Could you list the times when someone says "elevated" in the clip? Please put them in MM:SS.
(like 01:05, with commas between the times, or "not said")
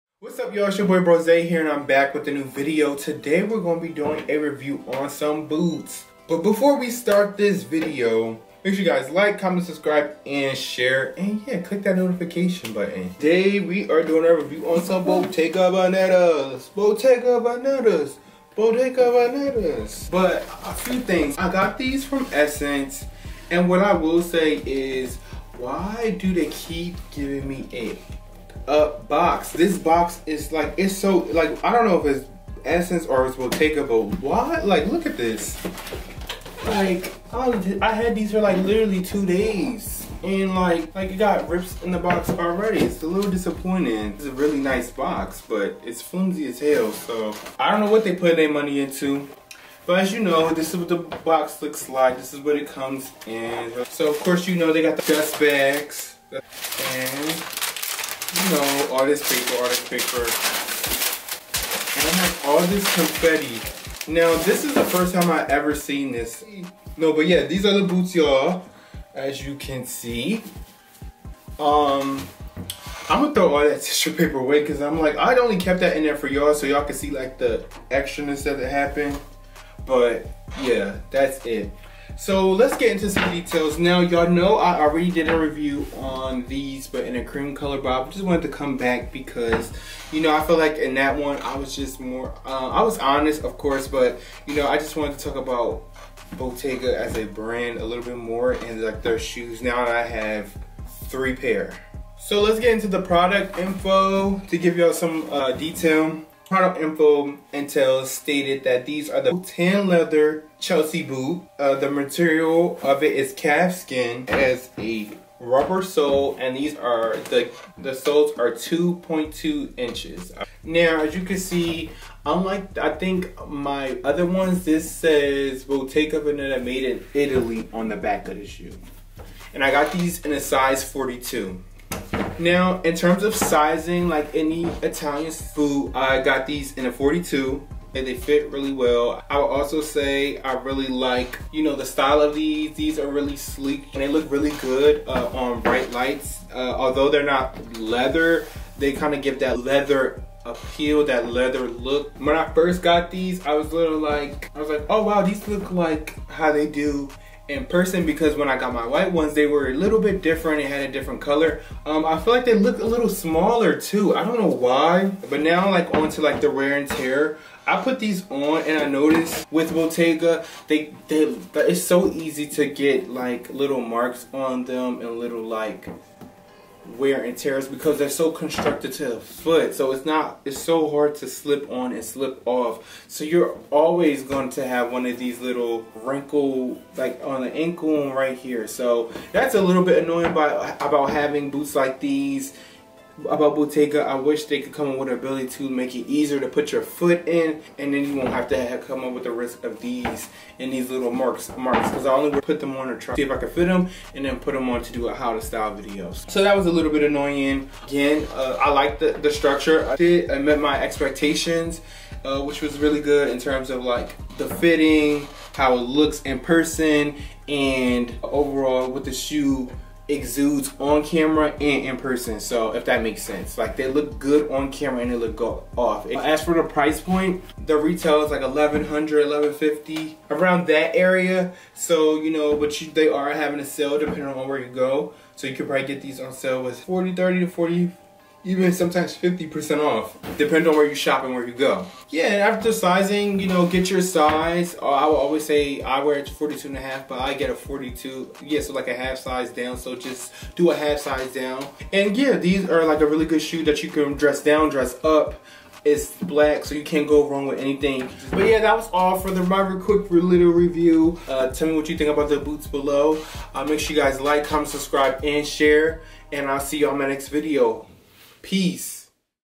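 not said.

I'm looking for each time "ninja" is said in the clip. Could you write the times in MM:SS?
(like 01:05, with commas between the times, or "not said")
not said.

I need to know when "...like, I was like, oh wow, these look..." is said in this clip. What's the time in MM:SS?
02:33.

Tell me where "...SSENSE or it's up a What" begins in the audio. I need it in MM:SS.
00:32.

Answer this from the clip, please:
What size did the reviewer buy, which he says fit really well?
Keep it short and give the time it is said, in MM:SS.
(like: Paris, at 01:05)
42, at 02:10.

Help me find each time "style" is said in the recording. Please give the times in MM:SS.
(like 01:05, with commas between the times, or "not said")
02:21, 03:25.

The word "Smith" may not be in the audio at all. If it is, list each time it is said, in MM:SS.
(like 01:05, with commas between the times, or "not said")
not said.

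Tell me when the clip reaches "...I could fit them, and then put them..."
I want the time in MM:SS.
03:23.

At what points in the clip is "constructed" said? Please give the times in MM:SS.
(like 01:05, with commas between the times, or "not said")
02:58.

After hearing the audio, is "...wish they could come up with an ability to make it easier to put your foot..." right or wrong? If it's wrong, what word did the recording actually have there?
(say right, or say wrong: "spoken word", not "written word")
right.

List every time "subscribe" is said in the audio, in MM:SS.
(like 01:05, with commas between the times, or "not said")
00:09, 04:24.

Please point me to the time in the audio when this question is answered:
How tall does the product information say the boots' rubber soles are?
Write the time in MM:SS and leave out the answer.
01:58.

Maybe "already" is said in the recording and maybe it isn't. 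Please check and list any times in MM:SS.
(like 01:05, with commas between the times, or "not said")
00:42, 01:24.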